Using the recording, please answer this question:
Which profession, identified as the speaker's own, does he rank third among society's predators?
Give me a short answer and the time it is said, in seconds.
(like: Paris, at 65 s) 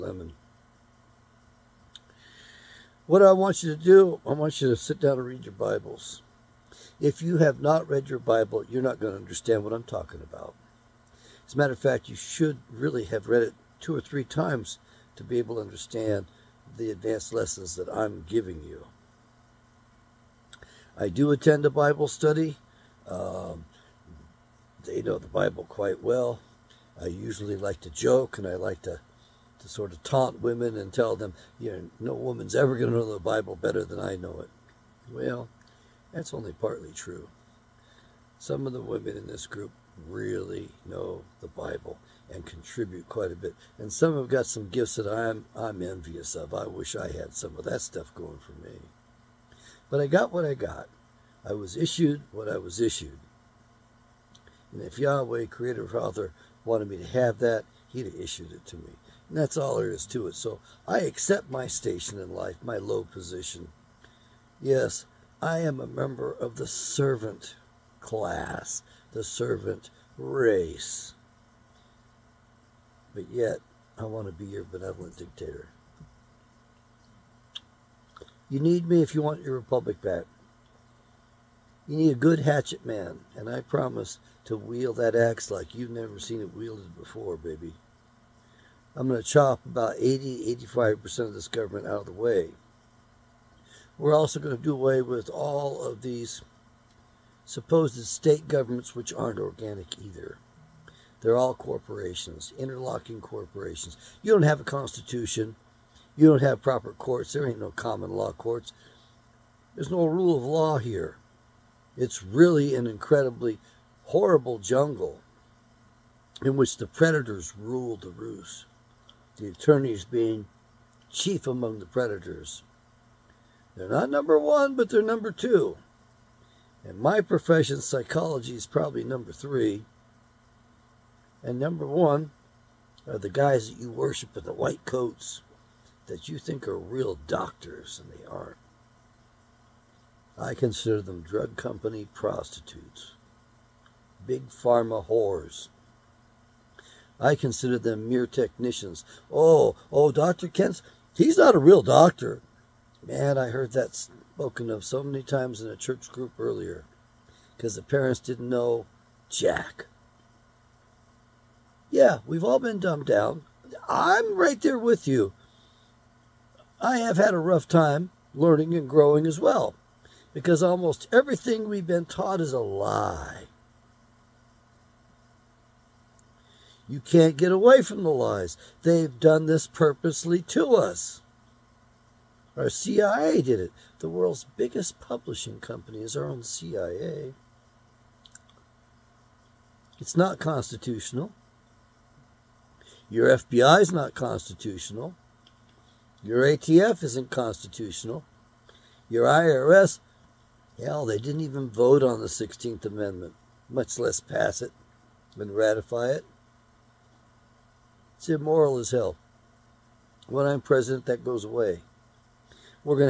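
Psychology, at 127 s.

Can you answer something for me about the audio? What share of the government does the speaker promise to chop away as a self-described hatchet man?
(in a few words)
80-85%.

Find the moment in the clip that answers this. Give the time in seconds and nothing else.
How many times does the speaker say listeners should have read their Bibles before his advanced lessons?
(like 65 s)
13 s.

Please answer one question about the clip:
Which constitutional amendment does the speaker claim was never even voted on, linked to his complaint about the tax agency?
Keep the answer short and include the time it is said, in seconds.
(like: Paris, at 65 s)
16th Amendment, at 202 s.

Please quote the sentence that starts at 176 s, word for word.
You can't get away from the lies.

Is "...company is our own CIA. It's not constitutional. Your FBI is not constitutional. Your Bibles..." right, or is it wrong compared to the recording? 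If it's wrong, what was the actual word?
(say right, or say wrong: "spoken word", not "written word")
wrong: "ATF", not "Bibles".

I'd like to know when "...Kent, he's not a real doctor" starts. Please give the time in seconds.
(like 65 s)
150 s.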